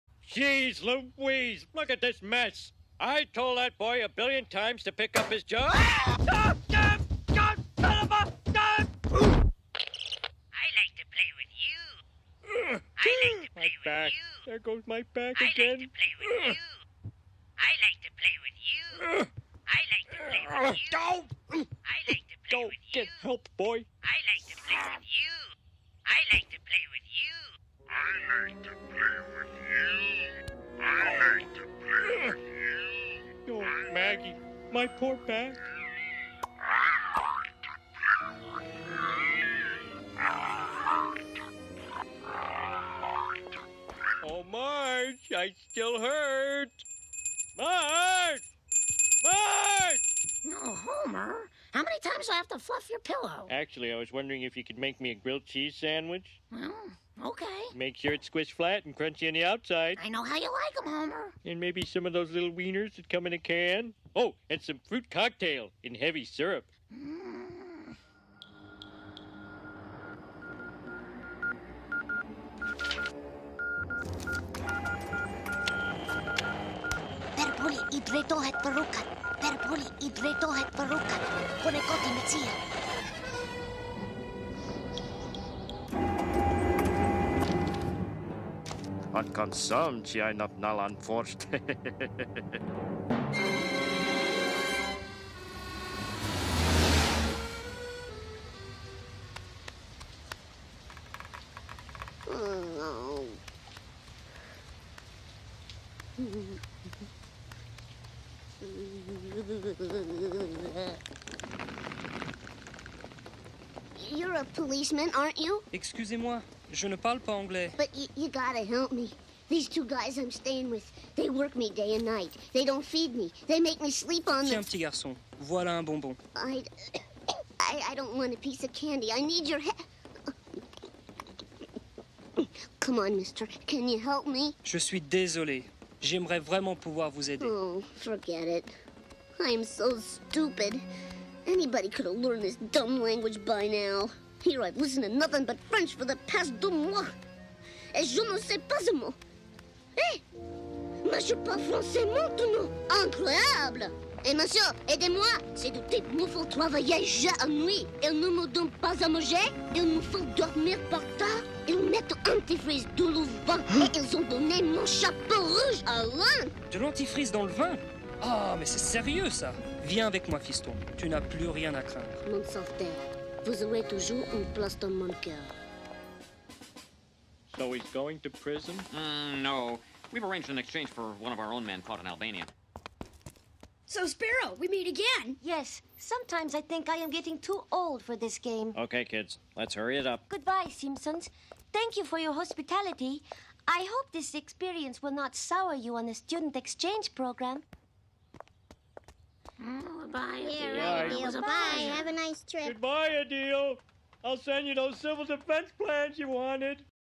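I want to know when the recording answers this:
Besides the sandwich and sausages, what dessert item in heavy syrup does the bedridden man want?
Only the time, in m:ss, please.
1:04.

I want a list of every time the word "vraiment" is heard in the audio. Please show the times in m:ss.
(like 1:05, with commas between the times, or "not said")
2:16.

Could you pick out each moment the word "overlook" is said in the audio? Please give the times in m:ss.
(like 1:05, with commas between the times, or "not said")
not said.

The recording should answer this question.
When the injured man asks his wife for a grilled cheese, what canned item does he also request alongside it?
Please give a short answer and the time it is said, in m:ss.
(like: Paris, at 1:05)
little wieners, at 1:02.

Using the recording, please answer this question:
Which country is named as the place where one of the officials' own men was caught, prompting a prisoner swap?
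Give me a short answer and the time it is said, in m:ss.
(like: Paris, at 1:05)
Albania, at 3:02.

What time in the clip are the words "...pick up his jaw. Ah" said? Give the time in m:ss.
0:04.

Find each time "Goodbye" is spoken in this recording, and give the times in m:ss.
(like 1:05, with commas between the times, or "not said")
3:10, 3:22.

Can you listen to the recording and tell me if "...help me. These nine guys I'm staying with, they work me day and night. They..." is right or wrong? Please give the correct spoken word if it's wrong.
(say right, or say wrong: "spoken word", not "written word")
wrong: "two", not "nine".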